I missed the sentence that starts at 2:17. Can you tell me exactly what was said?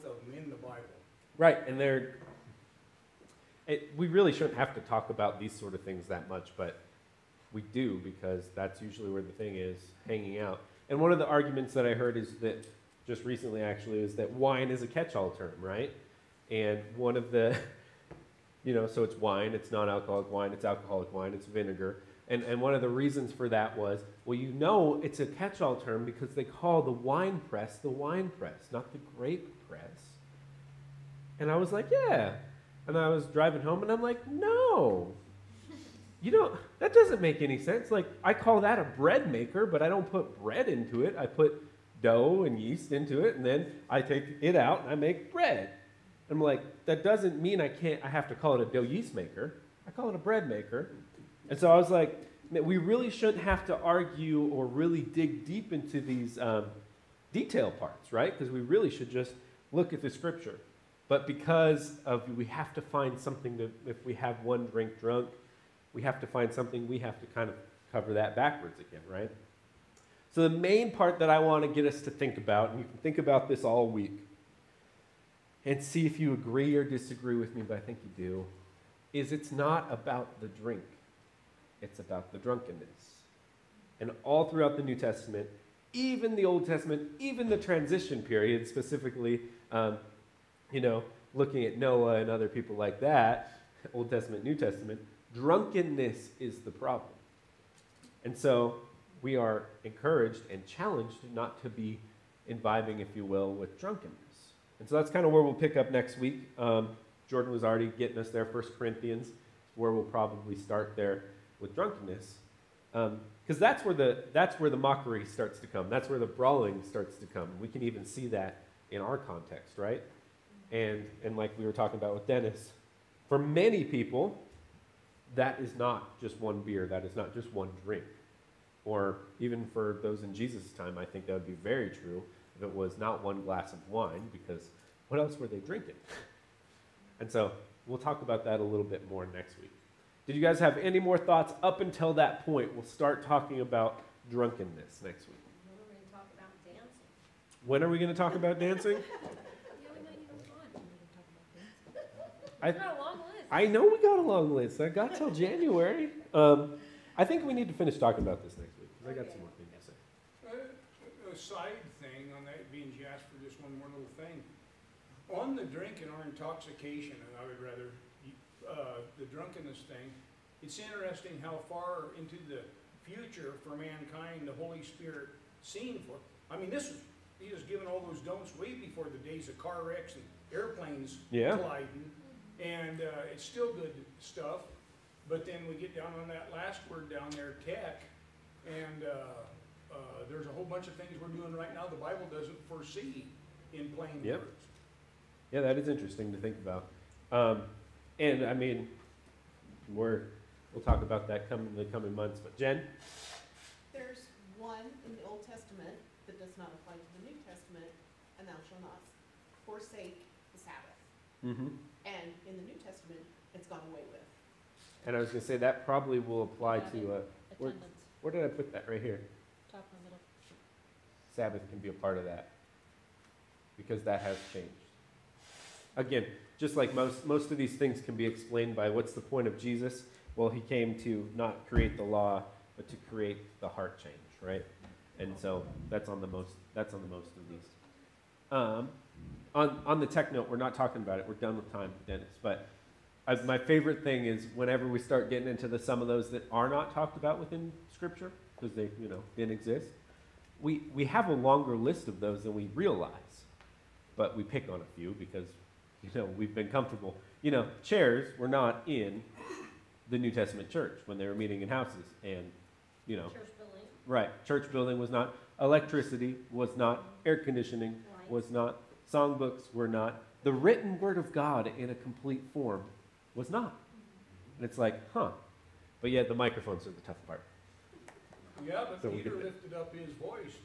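and so we'll talk about that a little bit more next week.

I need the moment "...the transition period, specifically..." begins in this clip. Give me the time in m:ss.
1:27.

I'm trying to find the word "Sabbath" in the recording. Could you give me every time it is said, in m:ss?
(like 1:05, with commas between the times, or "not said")
3:30, 3:41.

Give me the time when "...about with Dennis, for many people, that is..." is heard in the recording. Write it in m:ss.
2:01.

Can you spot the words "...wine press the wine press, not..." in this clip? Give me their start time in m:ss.
0:26.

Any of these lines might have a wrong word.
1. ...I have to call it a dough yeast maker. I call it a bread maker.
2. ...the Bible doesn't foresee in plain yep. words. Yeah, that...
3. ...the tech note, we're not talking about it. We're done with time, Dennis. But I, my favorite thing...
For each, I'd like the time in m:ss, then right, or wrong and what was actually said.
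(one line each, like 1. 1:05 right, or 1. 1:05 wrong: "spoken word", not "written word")
1. 0:48 right
2. 3:11 right
3. 3:59 right.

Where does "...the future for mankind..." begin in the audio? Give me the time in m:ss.
2:52.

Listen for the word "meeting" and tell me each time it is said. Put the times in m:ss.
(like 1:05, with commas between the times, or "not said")
4:21.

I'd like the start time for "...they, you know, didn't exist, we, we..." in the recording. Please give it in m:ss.
4:08.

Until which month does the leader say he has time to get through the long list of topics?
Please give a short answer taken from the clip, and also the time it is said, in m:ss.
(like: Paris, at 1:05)
January, at 2:35.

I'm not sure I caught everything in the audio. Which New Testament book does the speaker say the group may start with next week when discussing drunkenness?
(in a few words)
1 Corinthians.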